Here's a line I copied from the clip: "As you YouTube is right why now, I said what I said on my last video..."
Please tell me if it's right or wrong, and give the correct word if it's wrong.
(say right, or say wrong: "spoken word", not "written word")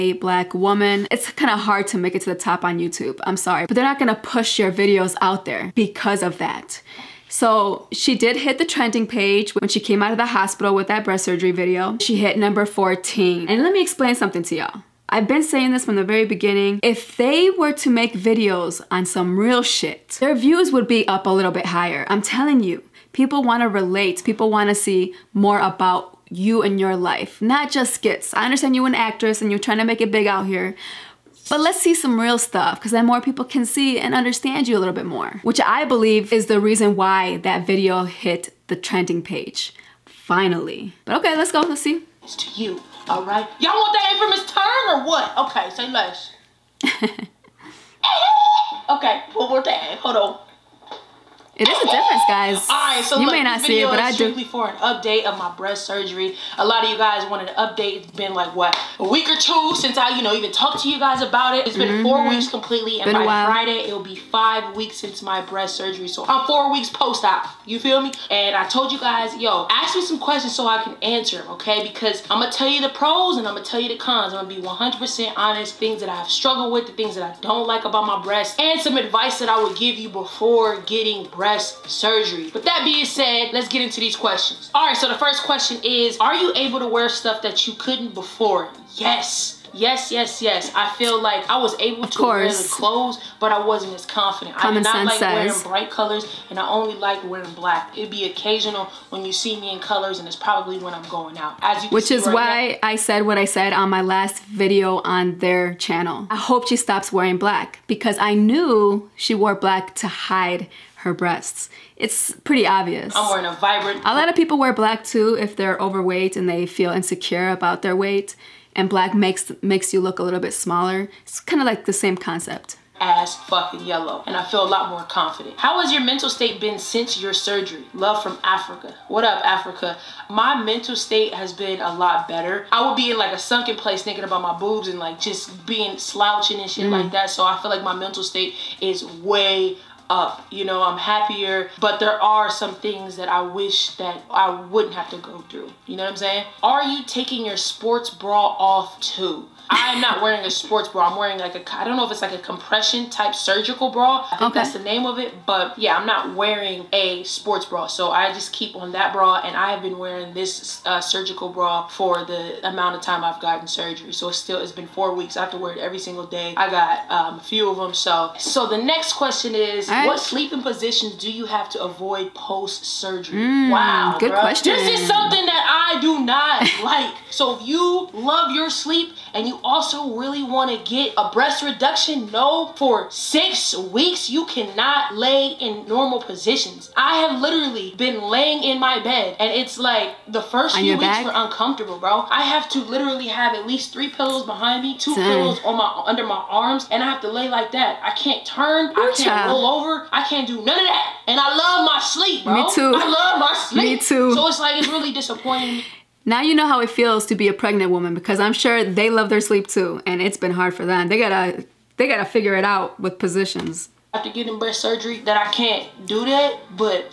wrong: "Which", not "YouTube".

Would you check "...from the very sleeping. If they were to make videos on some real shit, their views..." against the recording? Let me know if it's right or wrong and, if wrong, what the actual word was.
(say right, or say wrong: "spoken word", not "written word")
wrong: "beginning", not "sleeping".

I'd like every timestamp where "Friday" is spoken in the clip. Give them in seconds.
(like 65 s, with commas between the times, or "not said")
63 s.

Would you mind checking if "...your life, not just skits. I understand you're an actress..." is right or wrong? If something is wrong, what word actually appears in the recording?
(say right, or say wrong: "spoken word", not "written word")
right.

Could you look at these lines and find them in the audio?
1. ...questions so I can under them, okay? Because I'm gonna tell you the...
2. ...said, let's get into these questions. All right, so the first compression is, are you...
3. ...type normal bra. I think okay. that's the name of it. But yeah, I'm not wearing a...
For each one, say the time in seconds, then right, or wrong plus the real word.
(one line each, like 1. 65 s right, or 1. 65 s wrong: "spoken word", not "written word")
1. 70 s wrong: "answer", not "under"
2. 83 s wrong: "question", not "compression"
3. 153 s wrong: "surgical", not "normal".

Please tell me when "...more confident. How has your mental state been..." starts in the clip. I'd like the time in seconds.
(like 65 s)
124 s.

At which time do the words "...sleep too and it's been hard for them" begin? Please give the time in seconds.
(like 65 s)
209 s.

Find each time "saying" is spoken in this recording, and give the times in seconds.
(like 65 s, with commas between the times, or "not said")
15 s, 146 s.